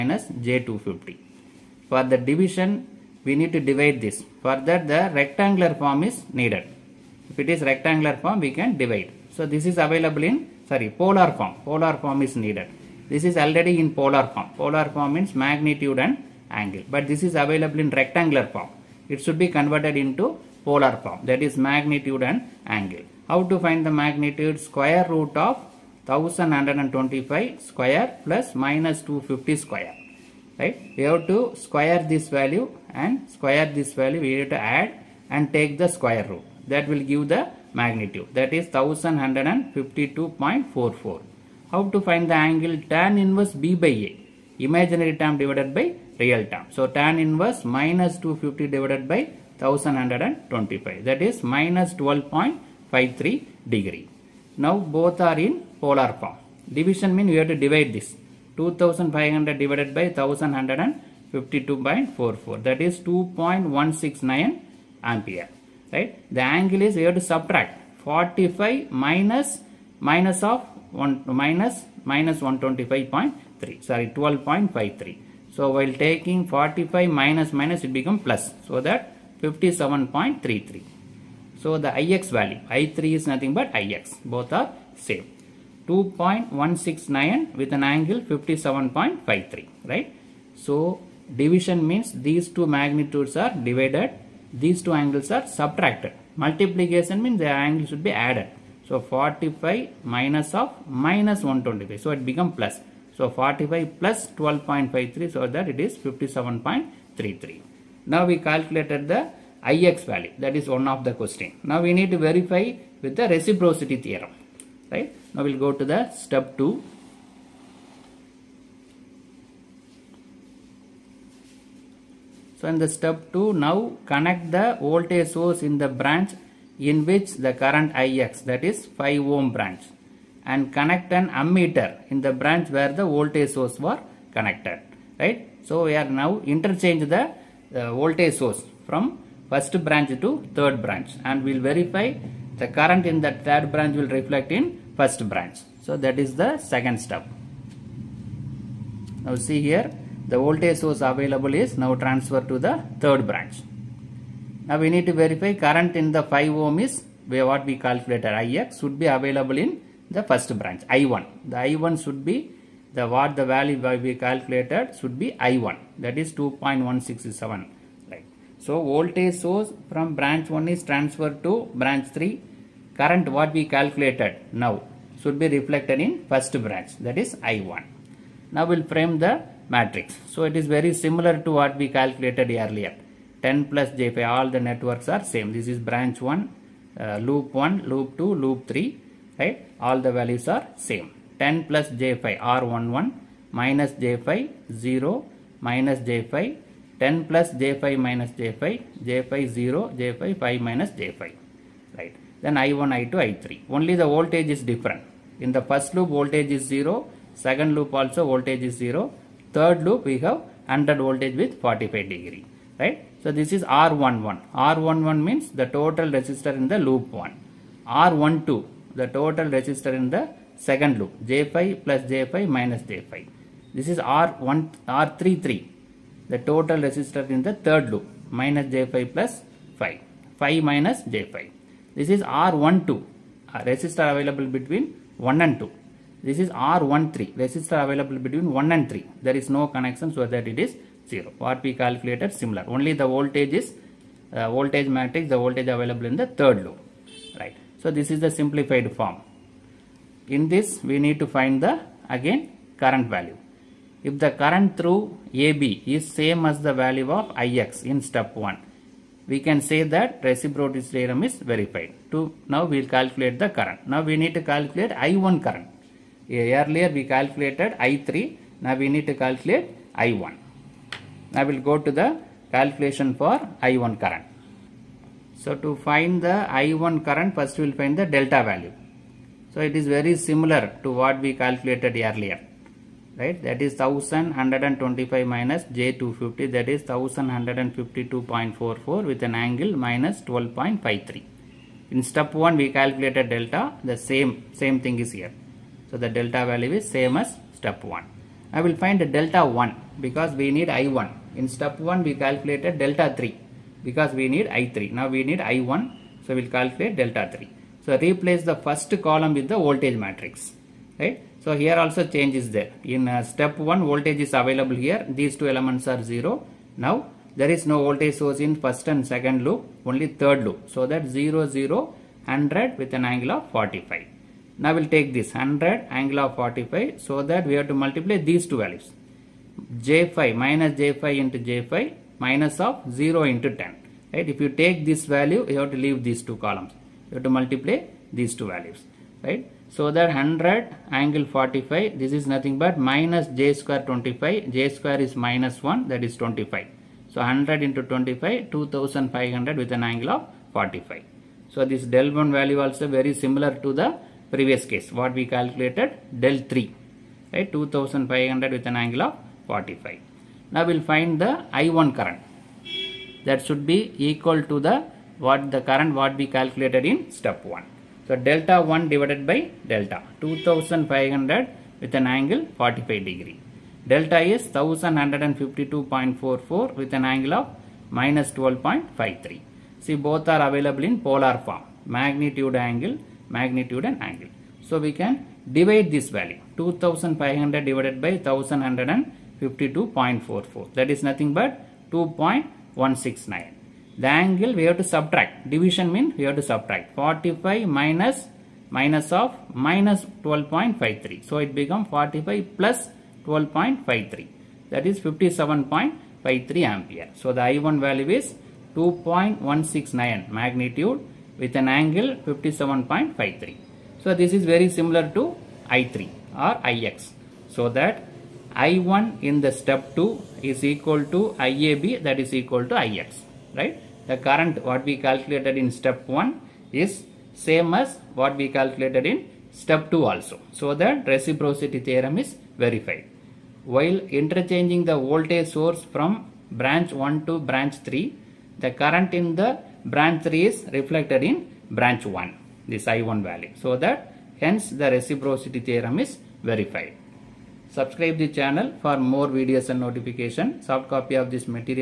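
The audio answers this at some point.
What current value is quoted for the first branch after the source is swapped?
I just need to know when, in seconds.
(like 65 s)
166 s.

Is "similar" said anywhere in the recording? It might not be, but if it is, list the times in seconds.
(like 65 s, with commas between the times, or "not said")
180 s, 242 s, 280 s, 353 s, 414 s.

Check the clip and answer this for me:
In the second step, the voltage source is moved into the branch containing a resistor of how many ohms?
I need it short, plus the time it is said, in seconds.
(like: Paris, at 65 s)
5 ohm, at 128 s.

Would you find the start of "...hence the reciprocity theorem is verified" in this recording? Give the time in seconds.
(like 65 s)
444 s.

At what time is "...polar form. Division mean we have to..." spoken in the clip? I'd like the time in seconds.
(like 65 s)
55 s.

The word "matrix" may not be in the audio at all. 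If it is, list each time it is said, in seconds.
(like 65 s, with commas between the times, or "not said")
179 s, 244 s, 309 s.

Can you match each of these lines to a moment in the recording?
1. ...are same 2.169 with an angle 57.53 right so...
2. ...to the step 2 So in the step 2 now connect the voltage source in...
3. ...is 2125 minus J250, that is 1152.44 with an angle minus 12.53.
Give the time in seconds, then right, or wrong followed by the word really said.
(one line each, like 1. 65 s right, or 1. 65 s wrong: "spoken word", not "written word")
1. 84 s right
2. 115 s right
3. 283 s wrong: "1125", not "2125".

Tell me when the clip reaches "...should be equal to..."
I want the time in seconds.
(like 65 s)
363 s.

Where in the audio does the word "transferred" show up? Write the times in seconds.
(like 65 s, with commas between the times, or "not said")
152 s, 170 s.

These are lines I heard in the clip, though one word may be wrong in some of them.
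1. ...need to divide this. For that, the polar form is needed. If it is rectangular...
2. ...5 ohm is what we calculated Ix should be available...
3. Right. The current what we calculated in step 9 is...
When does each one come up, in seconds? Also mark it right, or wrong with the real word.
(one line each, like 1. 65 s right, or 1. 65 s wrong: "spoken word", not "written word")
1. 3 s wrong: "rectangular", not "polar"
2. 156 s right
3. 423 s wrong: "1", not "9".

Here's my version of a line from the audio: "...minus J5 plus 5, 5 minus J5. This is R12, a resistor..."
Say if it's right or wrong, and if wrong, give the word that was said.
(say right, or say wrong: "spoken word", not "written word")
right.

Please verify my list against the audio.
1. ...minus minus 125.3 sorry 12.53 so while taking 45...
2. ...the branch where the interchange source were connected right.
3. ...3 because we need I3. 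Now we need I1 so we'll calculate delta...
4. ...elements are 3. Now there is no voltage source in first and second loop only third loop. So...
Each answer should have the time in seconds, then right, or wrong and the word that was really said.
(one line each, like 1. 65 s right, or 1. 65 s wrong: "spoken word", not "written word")
1. 71 s right
2. 132 s wrong: "voltage", not "interchange"
3. 303 s right
4. 315 s wrong: "0", not "3".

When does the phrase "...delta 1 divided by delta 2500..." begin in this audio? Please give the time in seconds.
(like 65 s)
368 s.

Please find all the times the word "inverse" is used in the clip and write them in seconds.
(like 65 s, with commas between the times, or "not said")
43 s, 47 s.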